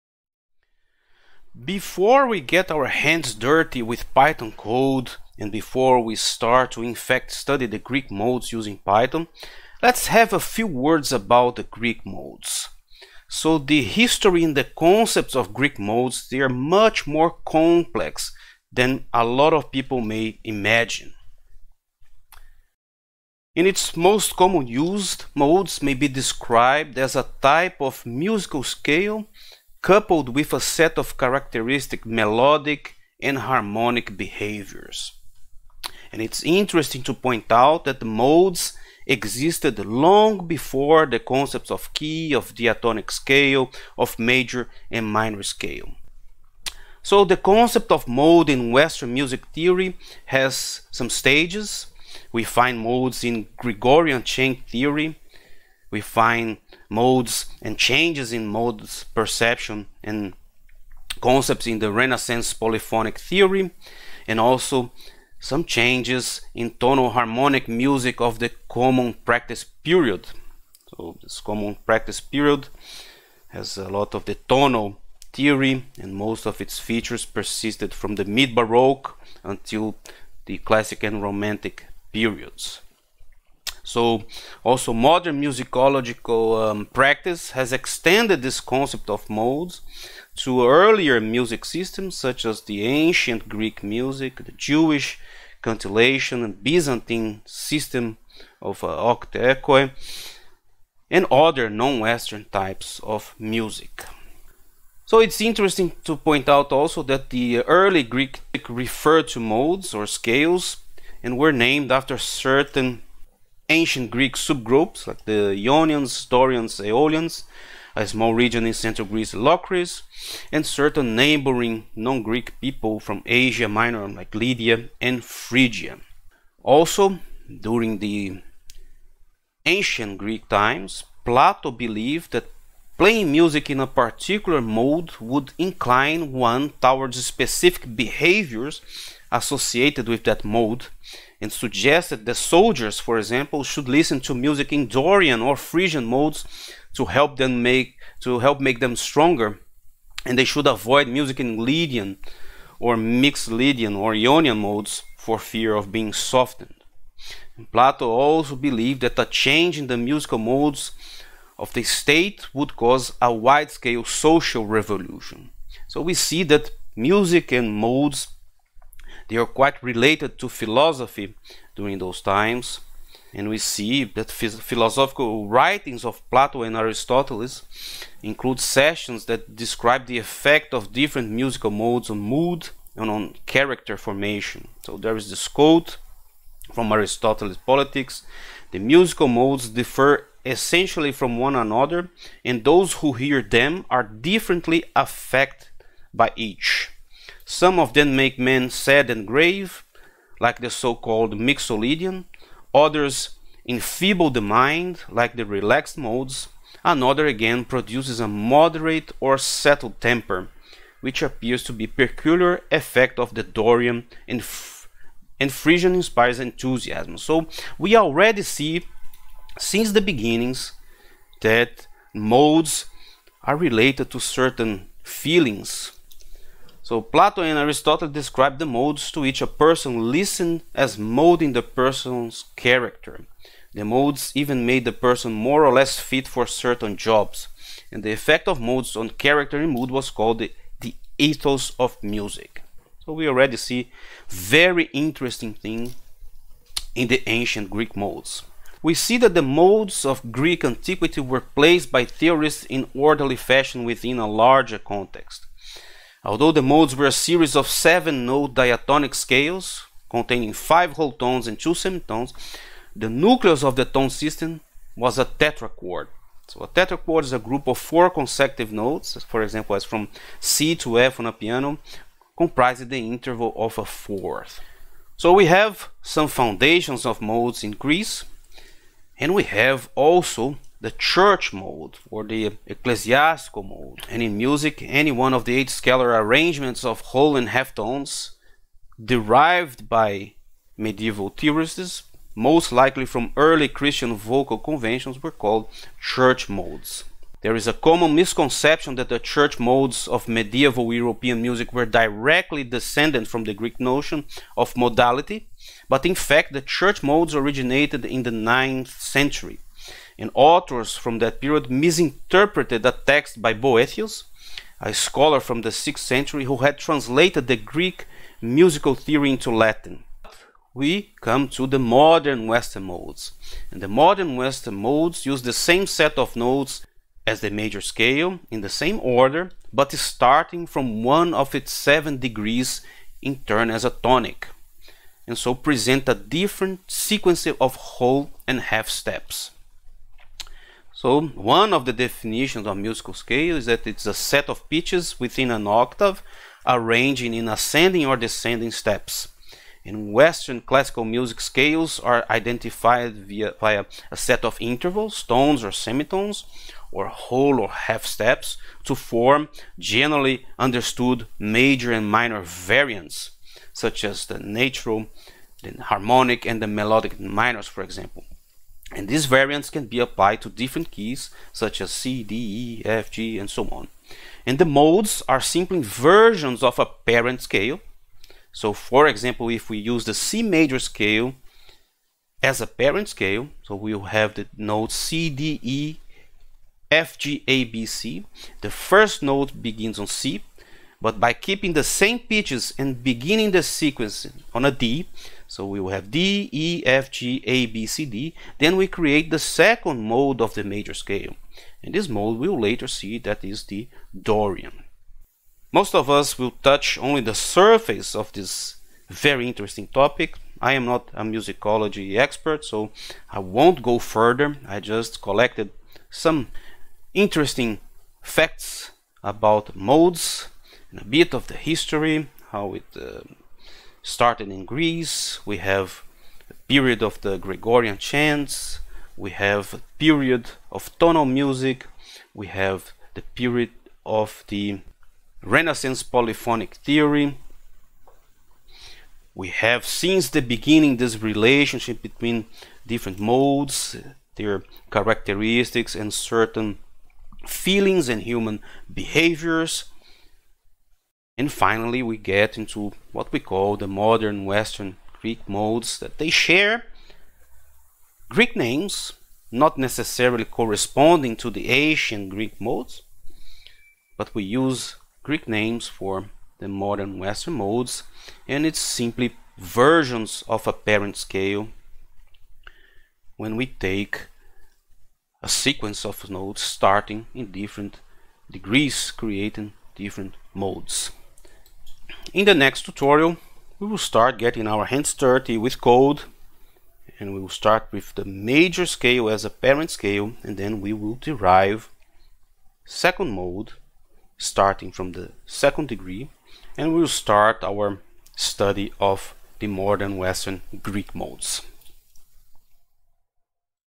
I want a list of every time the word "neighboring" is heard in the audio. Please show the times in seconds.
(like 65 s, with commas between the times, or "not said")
121 s.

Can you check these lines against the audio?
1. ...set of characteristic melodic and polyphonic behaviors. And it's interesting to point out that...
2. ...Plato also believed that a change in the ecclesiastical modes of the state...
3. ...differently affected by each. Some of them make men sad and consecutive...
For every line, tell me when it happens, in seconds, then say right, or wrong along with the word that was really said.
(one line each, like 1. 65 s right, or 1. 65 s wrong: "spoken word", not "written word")
1. 30 s wrong: "harmonic", not "polyphonic"
2. 157 s wrong: "musical", not "ecclesiastical"
3. 194 s wrong: "grave", not "consecutive".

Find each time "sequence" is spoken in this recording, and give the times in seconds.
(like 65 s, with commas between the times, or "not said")
336 s, 393 s, 475 s.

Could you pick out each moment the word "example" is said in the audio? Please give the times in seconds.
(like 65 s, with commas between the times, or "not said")
143 s, 269 s, 367 s, 379 s.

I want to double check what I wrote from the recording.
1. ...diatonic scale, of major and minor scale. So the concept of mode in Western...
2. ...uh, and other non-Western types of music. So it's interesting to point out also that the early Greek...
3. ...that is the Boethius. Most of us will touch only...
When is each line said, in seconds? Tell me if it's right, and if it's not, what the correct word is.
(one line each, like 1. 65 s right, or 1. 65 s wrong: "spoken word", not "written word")
1. 42 s right
2. 98 s right
3. 403 s wrong: "Dorian", not "Boethius".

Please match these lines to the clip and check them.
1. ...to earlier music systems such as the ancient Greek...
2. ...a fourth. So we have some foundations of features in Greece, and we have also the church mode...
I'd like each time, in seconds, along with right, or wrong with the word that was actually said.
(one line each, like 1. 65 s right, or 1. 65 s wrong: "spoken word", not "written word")
1. 90 s right
2. 273 s wrong: "modes", not "features".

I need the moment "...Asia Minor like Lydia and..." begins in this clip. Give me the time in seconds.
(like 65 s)
123 s.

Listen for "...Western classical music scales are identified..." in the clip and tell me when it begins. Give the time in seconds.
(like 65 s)
350 s.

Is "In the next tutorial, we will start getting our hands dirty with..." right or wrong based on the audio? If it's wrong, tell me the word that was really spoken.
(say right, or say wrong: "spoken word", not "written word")
right.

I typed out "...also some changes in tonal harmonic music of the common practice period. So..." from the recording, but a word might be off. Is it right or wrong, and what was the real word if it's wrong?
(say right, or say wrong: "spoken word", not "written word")
right.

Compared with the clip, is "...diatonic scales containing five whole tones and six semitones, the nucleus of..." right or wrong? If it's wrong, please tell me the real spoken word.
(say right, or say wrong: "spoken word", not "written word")
wrong: "two", not "six".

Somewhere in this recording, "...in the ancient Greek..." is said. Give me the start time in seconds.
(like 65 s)
246 s.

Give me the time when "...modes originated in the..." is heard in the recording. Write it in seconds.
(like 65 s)
307 s.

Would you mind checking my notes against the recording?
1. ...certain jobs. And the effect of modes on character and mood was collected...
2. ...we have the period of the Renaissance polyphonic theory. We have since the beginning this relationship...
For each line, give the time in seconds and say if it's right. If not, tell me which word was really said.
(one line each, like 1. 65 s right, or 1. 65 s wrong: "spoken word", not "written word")
1. 236 s wrong: "called", not "collected"
2. 432 s right.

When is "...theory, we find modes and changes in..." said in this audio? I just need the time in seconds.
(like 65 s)
54 s.